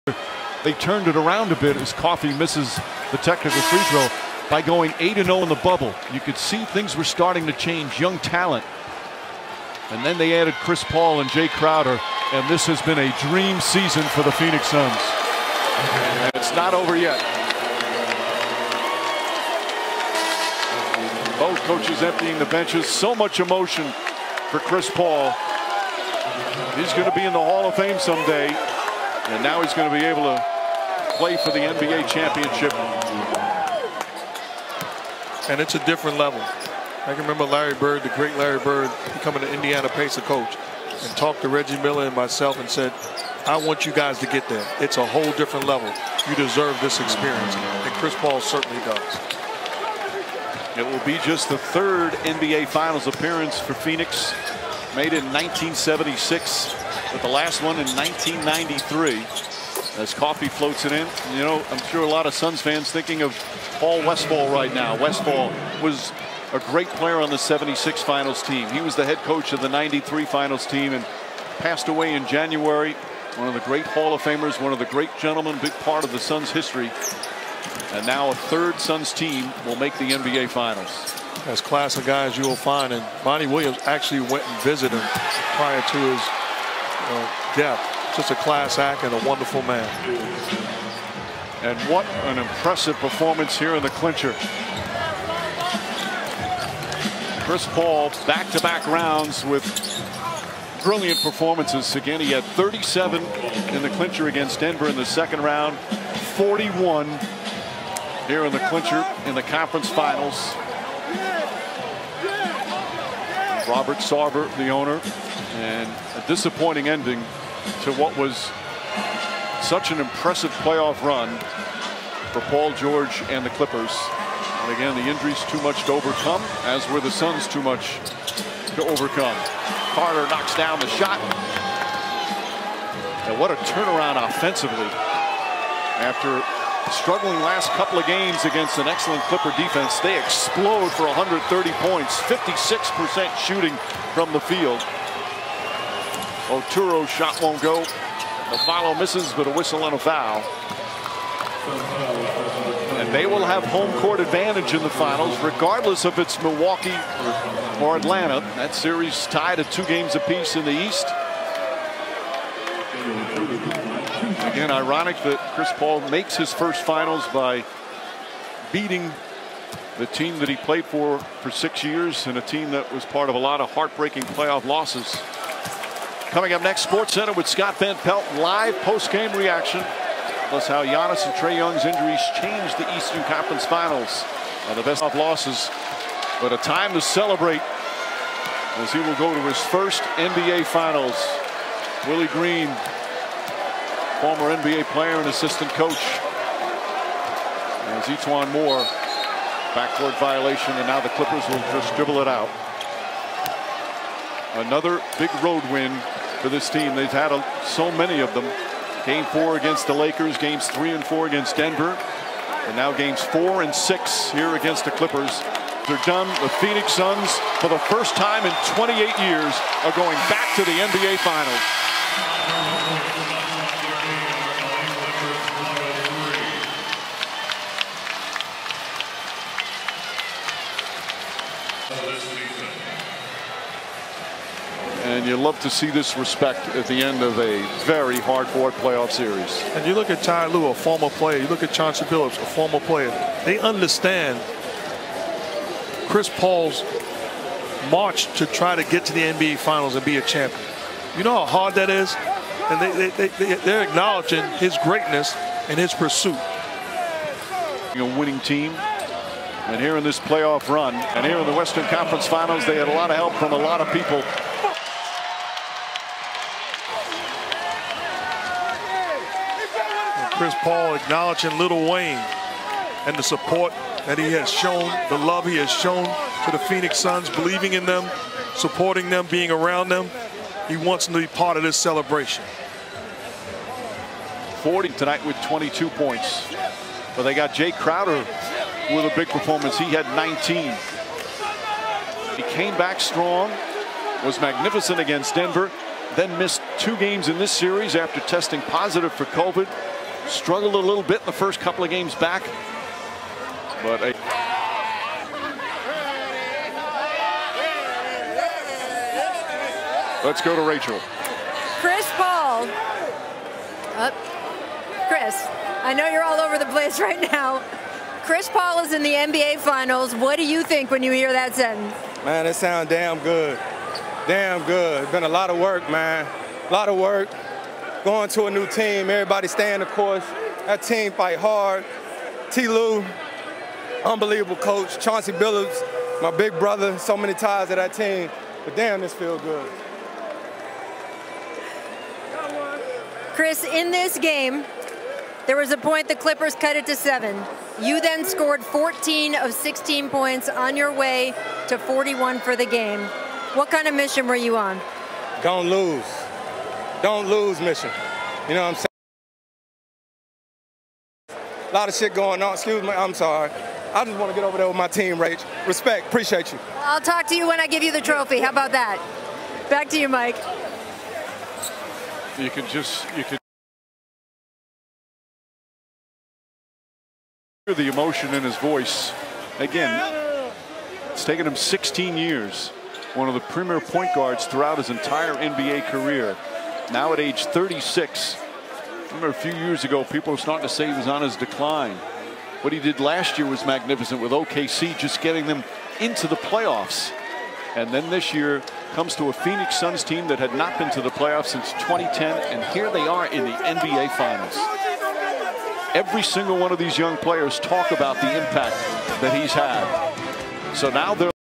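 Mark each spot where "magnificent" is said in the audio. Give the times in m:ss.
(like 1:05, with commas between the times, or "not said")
4:54, 6:33.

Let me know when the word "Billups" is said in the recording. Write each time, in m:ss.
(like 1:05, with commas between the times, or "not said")
4:02, 5:35.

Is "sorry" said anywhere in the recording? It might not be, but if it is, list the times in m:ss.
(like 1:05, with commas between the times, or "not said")
6:03.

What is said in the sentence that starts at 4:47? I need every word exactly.
But they got Jae Crowder with a big performance.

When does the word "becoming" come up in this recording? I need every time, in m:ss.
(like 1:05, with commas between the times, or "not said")
0:39.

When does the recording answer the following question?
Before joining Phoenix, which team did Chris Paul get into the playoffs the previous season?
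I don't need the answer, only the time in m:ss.
6:34.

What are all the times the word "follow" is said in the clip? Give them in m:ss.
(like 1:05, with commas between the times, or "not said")
2:28.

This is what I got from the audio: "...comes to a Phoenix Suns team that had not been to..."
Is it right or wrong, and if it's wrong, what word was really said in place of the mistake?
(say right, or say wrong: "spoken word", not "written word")
right.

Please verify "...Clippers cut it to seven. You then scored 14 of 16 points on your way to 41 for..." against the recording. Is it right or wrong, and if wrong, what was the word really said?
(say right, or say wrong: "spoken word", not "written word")
right.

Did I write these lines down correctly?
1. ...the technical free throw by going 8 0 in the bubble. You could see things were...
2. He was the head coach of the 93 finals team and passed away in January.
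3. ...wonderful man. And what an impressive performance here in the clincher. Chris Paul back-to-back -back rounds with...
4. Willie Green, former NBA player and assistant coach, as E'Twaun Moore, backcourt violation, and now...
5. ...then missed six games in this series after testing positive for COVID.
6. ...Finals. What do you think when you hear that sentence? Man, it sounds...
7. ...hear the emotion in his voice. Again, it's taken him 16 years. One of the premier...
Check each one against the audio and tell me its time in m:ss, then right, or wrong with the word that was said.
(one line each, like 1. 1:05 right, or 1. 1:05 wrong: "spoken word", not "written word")
1. 0:03 right
2. 1:08 right
3. 1:29 right
4. 3:12 right
5. 4:56 wrong: "two", not "six"
6. 5:19 right
7. 6:17 right.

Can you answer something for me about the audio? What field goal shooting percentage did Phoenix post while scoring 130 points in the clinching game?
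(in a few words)
56%.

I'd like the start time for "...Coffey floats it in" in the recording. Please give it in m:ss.
1:00.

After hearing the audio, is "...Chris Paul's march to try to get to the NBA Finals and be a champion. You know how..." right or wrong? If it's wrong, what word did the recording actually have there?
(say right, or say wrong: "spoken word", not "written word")
right.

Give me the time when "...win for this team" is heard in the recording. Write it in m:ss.
3:25.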